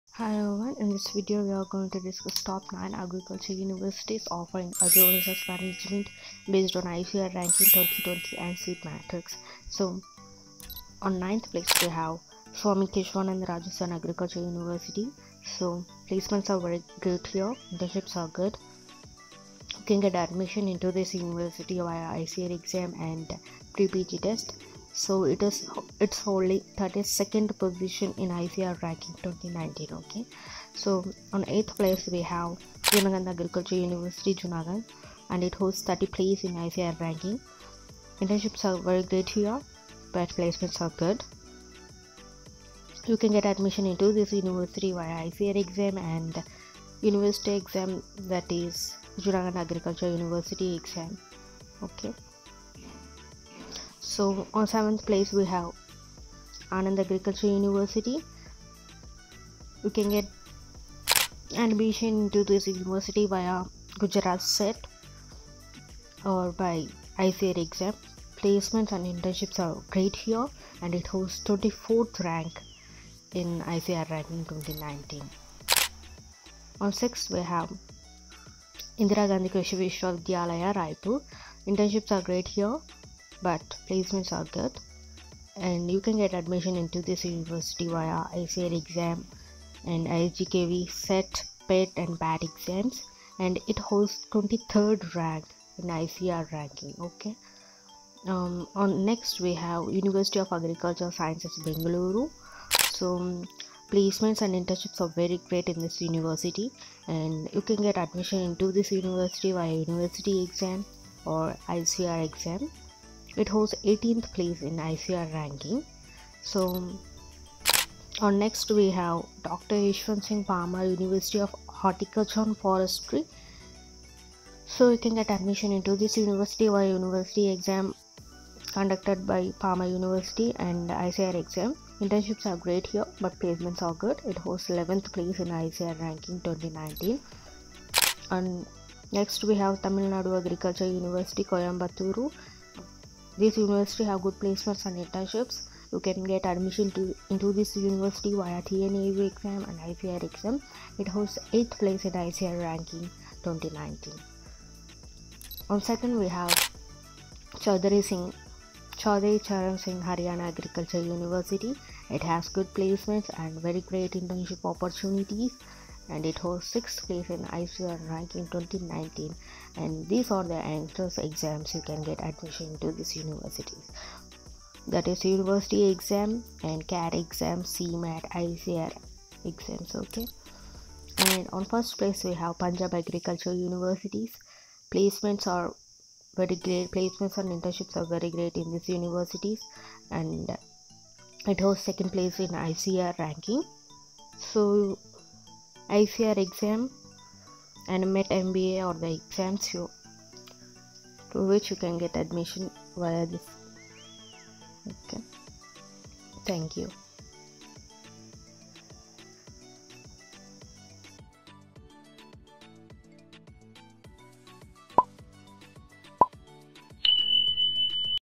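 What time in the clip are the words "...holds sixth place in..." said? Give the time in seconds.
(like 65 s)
166 s.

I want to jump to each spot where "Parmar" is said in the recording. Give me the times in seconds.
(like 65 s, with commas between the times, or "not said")
120 s, 129 s.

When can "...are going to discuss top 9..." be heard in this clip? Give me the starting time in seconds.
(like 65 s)
1 s.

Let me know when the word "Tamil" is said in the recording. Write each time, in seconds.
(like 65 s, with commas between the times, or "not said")
139 s.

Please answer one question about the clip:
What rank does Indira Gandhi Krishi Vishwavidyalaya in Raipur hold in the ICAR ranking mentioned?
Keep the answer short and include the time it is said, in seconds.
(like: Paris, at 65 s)
23rd, at 94 s.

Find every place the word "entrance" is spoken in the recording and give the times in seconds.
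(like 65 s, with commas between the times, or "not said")
170 s.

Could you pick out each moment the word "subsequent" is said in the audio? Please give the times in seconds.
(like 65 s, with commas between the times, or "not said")
not said.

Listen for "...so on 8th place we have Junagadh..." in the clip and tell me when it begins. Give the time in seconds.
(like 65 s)
30 s.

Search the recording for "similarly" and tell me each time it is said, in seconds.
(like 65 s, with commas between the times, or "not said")
not said.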